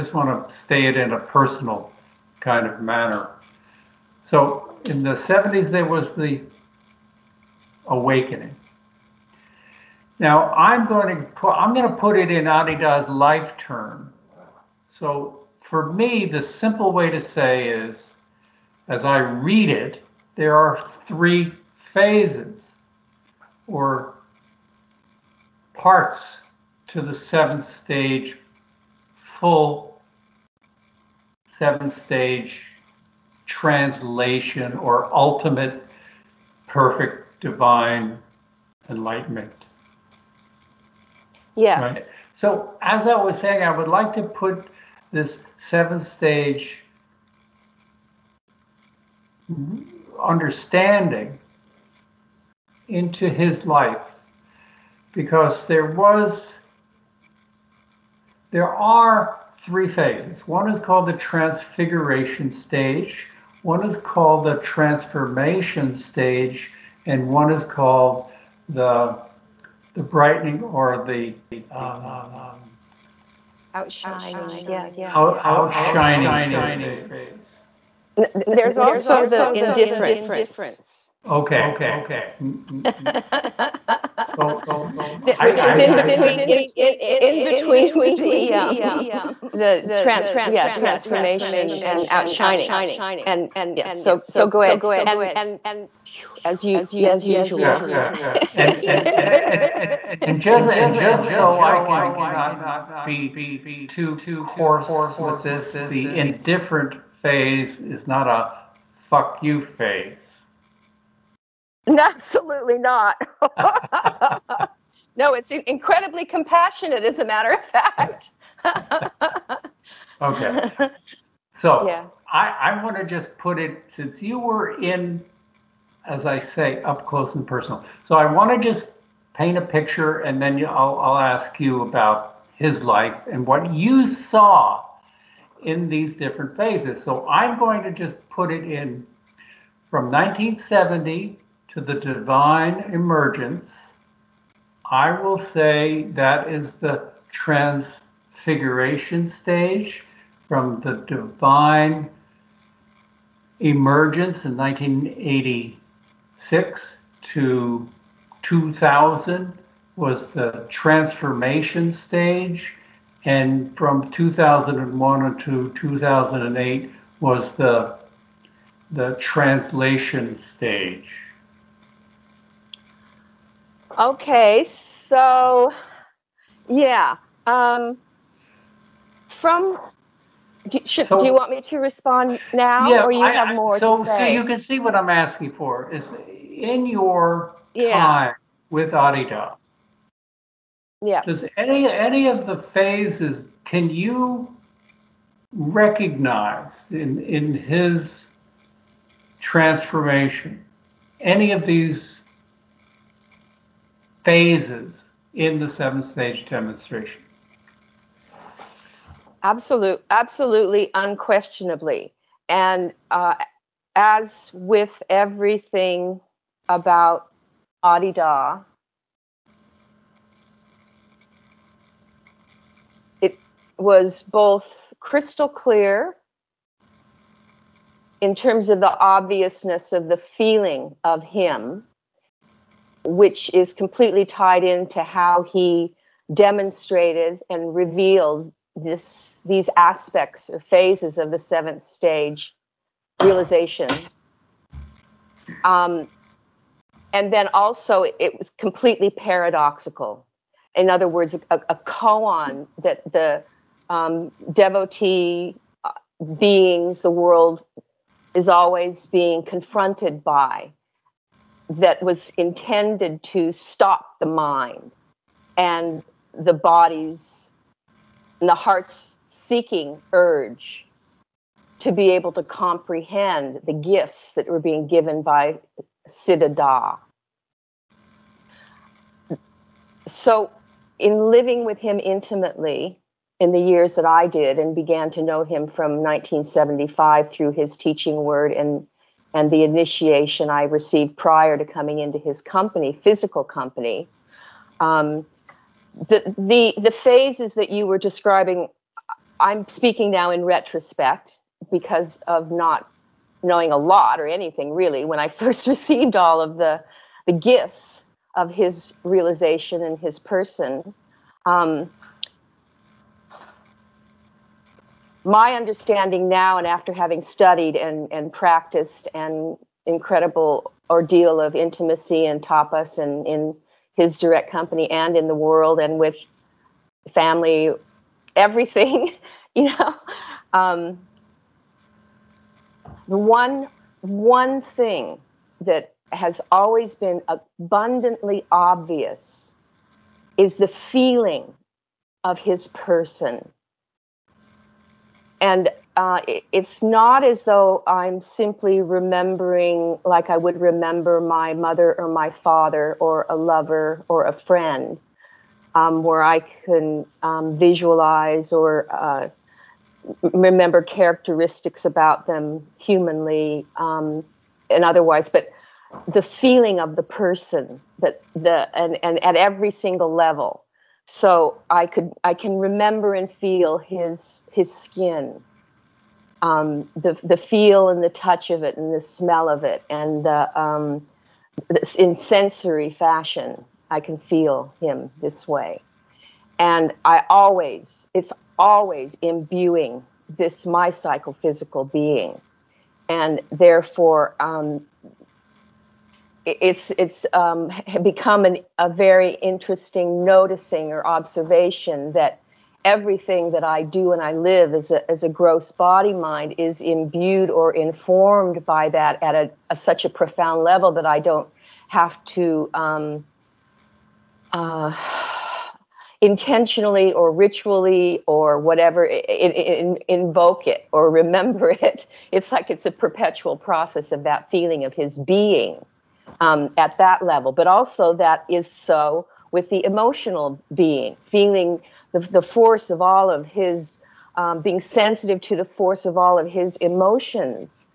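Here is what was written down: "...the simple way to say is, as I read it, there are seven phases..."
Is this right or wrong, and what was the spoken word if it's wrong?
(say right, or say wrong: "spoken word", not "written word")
wrong: "three", not "seven".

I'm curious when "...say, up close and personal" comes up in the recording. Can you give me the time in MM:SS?
02:06.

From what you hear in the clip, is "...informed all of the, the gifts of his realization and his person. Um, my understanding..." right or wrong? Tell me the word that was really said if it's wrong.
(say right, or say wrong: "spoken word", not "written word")
wrong: "received", not "informed".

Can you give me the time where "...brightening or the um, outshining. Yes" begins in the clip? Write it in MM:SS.
01:10.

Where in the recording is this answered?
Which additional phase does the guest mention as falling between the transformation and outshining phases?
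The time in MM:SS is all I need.
01:19.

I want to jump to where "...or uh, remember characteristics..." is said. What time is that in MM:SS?
05:58.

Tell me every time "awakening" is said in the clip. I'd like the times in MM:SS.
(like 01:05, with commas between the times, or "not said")
00:07.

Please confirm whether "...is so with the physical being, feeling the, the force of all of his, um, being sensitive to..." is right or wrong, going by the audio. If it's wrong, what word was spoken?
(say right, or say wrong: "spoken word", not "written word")
wrong: "emotional", not "physical".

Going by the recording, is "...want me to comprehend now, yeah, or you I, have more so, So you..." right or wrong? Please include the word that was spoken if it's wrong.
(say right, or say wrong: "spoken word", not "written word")
wrong: "respond", not "comprehend".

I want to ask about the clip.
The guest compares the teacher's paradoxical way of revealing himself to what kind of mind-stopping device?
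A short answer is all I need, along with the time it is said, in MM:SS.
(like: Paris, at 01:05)
A koan, at 04:11.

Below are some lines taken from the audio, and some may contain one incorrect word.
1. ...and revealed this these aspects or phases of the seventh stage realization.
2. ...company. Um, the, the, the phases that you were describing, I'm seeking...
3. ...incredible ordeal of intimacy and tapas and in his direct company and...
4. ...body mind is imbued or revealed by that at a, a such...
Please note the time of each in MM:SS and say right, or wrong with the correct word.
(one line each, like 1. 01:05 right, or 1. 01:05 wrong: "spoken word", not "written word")
1. 03:57 right
2. 04:53 wrong: "speaking", not "seeking"
3. 05:19 right
4. 06:45 wrong: "informed", not "revealed".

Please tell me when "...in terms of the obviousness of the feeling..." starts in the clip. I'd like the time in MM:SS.
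03:48.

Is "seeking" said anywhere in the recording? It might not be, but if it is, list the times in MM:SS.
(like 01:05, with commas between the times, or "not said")
04:29.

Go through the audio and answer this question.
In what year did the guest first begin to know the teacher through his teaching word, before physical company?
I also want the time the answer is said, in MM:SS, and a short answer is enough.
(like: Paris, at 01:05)
1975, at 04:45.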